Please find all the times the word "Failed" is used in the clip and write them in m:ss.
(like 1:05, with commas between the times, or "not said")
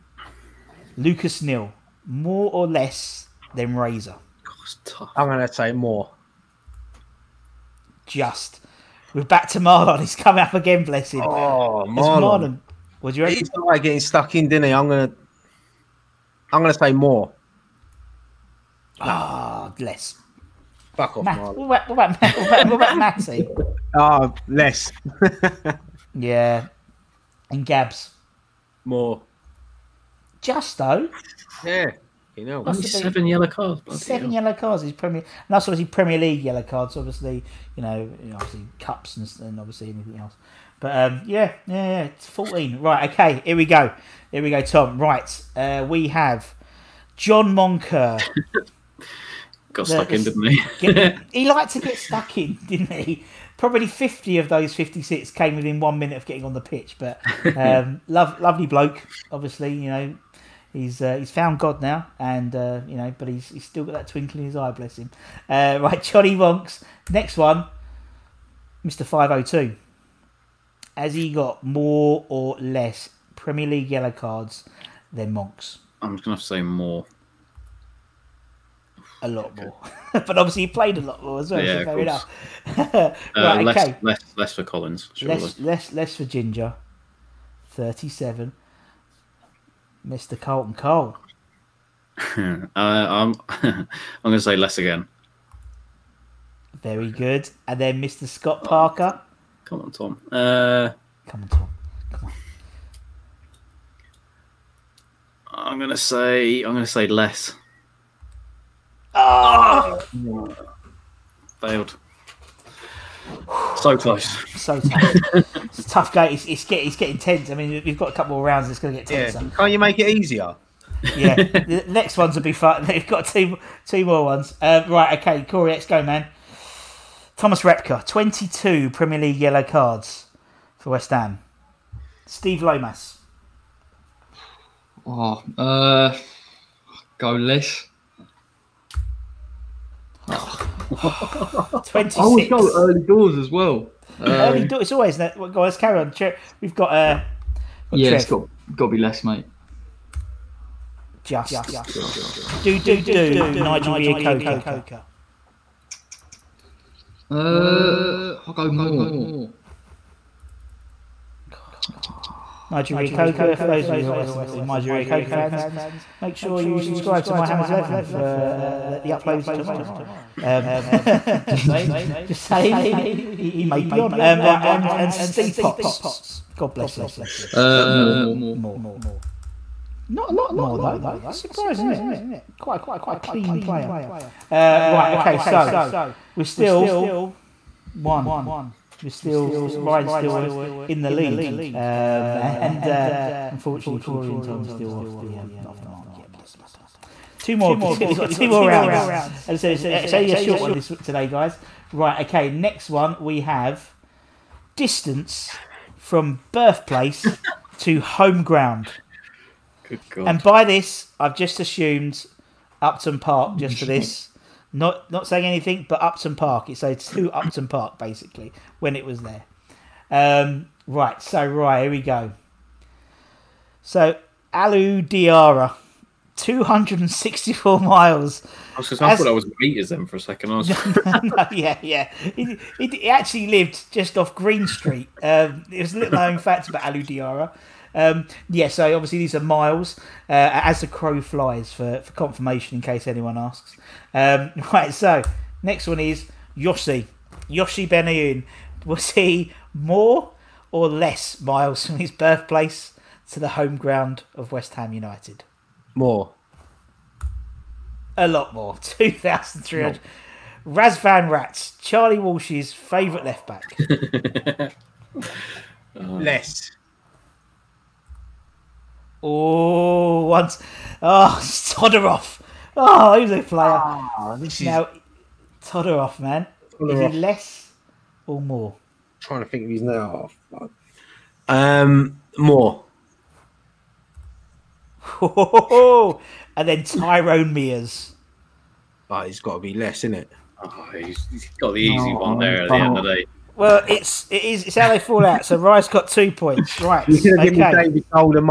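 1:51.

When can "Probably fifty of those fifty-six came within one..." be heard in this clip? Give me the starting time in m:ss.
0:53.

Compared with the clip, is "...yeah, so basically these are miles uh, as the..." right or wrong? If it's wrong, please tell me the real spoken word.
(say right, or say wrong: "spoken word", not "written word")
wrong: "obviously", not "basically".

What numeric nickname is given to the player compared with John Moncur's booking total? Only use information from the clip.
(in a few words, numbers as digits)
502.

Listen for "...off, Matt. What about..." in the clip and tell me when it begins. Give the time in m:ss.
0:21.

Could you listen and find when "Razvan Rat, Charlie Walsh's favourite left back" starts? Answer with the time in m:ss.
4:20.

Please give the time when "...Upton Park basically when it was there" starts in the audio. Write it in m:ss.
3:37.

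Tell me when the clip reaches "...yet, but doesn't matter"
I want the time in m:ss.
3:16.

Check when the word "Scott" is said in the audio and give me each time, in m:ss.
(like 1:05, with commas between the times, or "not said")
1:38.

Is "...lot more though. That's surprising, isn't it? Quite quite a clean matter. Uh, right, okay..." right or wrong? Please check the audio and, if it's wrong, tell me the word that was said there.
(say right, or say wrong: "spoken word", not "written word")
wrong: "player", not "matter".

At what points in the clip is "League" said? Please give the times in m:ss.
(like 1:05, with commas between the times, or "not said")
0:36, 1:13, 2:09.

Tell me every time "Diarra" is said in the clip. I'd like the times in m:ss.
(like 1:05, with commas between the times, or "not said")
3:45, 3:57.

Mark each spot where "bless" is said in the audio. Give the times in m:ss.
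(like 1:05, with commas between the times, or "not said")
0:10, 1:04, 2:56.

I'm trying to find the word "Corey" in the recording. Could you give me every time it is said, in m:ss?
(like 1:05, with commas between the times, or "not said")
2:05, 3:13.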